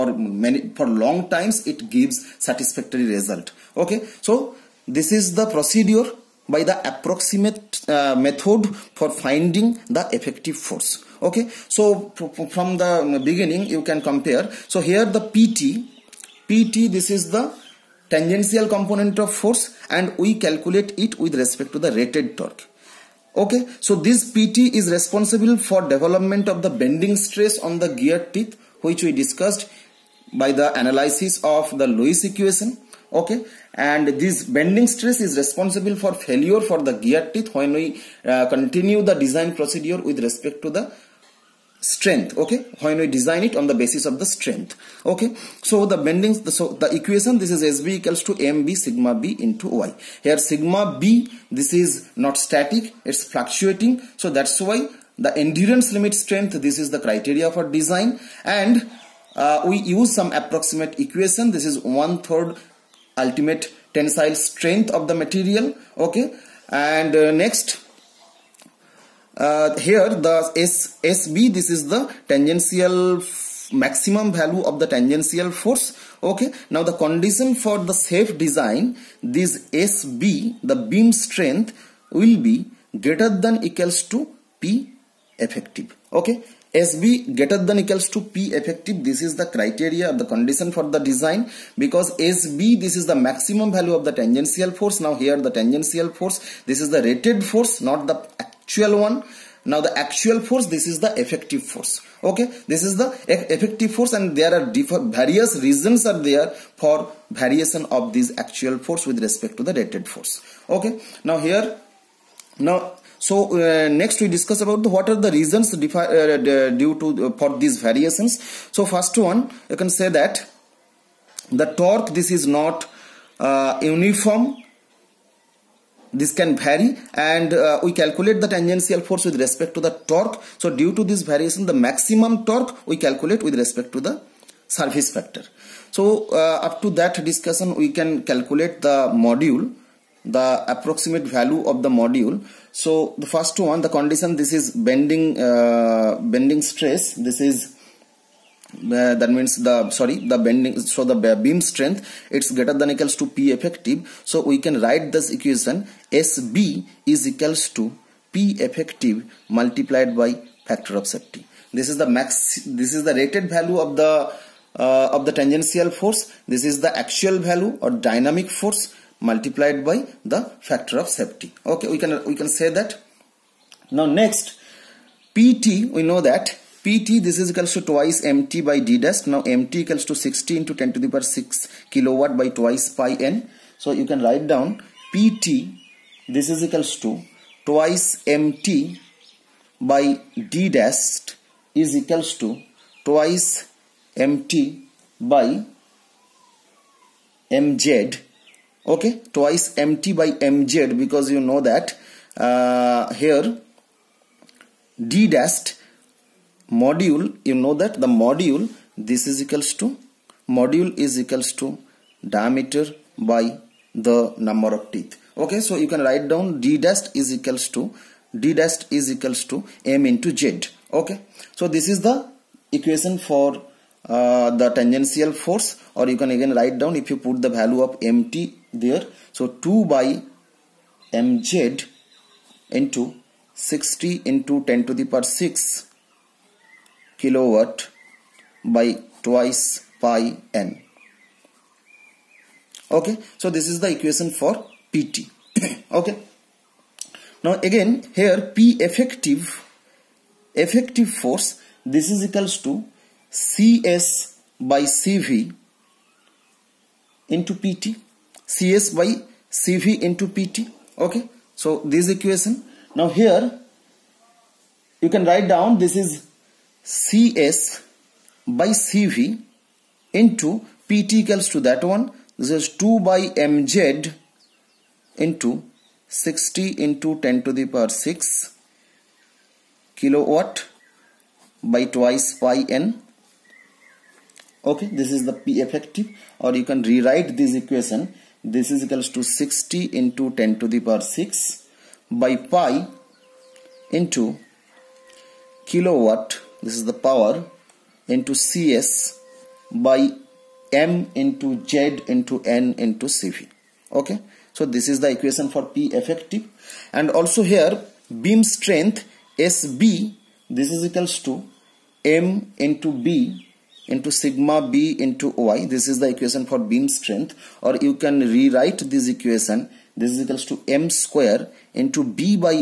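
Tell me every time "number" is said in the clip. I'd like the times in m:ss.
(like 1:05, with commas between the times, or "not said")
3:34.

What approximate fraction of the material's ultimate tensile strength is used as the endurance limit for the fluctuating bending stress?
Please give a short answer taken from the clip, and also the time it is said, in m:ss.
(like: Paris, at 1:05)
one third, at 1:01.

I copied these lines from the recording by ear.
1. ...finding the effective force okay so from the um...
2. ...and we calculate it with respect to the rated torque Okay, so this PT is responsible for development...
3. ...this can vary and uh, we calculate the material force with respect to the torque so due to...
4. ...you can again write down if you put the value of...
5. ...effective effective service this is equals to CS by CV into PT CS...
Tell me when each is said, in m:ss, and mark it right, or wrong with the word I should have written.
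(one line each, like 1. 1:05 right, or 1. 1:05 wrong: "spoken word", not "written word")
1. 0:09 right
2. 0:19 right
3. 2:06 wrong: "tangential", not "material"
4. 3:46 right
5. 4:08 wrong: "force", not "service".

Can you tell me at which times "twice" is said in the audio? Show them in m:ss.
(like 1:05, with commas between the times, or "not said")
2:57, 3:02, 3:07, 3:13, 3:19, 3:59, 4:41.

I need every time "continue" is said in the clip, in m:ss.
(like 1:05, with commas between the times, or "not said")
0:38.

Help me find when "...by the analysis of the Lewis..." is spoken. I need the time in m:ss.
0:30.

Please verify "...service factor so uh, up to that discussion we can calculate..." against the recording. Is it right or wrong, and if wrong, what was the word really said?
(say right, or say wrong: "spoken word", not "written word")
right.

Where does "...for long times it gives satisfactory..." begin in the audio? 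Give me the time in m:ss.
0:00.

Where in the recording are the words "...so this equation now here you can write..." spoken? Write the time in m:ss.
4:21.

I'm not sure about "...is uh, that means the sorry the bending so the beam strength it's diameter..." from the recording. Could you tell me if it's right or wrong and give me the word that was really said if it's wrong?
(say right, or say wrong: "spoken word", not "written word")
wrong: "greater", not "diameter".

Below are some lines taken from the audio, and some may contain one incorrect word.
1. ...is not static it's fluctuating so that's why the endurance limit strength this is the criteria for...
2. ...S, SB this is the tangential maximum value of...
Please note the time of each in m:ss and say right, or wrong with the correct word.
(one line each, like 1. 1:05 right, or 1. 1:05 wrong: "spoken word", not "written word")
1. 0:51 right
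2. 1:10 right.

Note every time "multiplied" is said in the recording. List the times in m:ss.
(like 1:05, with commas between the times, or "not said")
2:39, 2:49.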